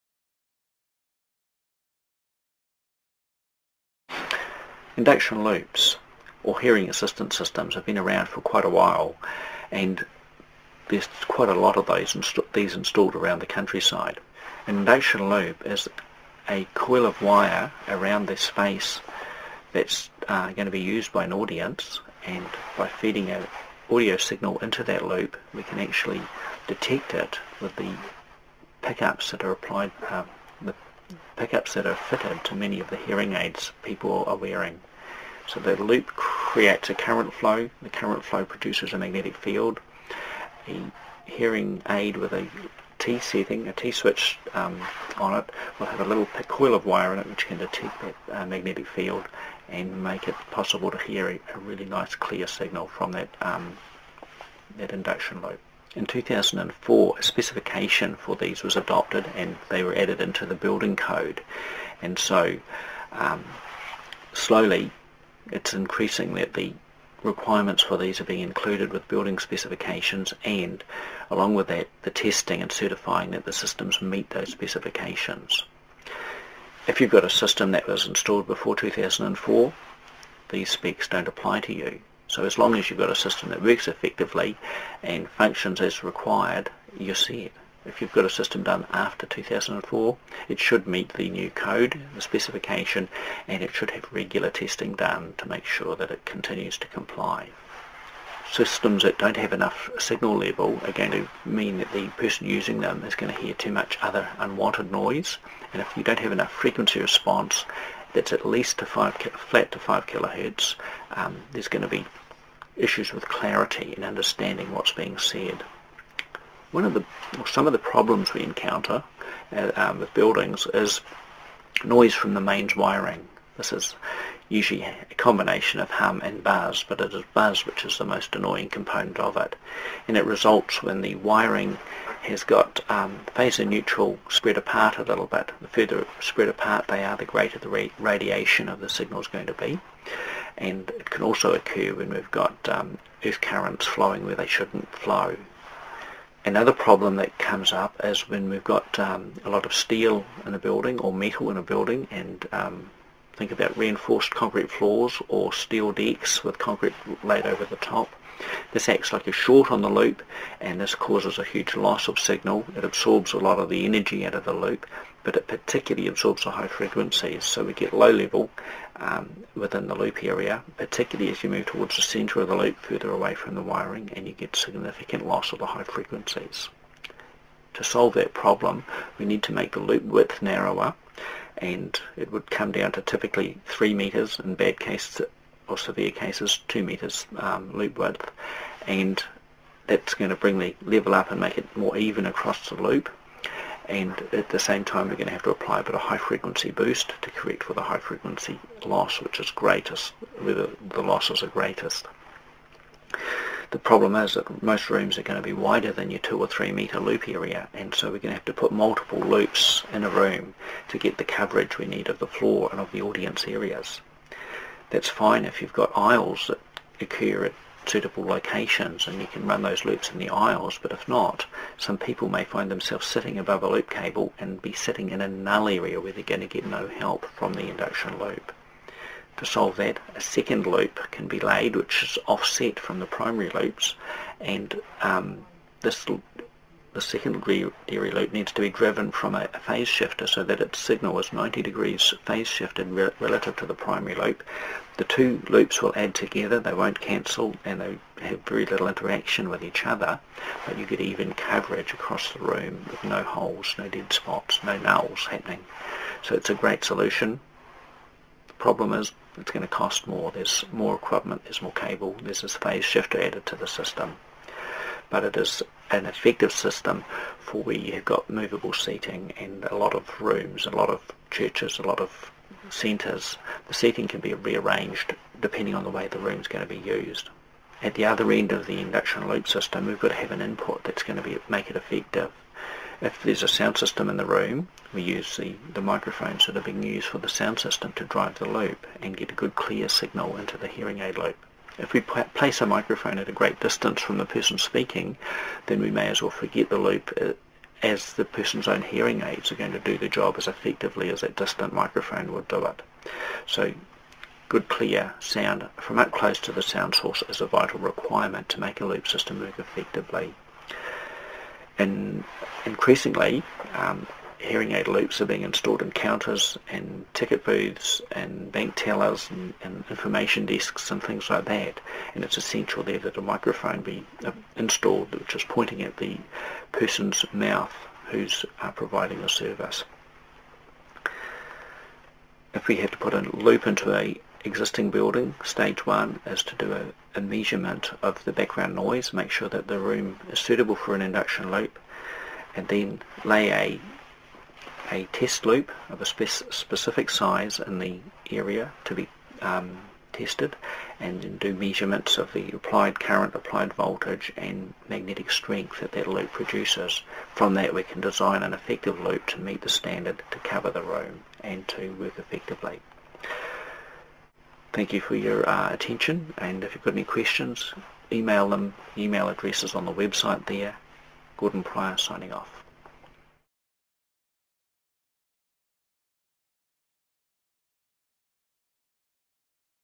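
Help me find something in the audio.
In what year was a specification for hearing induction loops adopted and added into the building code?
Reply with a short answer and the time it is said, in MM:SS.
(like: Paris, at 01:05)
2004, at 00:55.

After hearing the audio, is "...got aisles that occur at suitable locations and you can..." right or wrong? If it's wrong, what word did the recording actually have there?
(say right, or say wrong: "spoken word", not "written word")
right.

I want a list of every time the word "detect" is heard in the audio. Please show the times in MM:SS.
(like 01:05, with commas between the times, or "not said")
00:26, 00:47.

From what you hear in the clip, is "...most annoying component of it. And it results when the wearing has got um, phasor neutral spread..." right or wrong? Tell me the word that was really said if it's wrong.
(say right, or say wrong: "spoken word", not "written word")
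wrong: "wiring", not "wearing".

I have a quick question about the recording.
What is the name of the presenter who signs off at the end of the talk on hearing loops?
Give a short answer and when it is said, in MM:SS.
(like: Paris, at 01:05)
Gordon Prier, at 06:11.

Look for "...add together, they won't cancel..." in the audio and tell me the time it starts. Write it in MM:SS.
04:05.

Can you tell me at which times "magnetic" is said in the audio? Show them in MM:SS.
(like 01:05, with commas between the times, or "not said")
00:38, 00:48, 05:54.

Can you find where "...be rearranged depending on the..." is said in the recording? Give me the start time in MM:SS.
04:34.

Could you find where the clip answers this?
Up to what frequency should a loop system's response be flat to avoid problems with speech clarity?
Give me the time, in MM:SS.
01:49.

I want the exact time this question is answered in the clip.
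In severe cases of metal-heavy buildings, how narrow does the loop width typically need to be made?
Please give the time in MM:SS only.
03:06.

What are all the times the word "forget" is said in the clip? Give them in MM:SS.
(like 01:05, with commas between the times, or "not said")
04:56.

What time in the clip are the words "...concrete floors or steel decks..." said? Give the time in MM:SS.
02:34.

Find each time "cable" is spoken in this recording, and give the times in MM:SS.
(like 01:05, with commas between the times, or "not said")
03:43, 04:21.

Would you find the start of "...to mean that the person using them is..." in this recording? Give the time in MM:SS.
01:41.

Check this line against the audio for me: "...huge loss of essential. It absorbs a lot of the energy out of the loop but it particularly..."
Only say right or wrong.
wrong.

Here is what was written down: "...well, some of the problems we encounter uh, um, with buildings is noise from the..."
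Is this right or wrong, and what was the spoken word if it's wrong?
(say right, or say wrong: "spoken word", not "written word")
right.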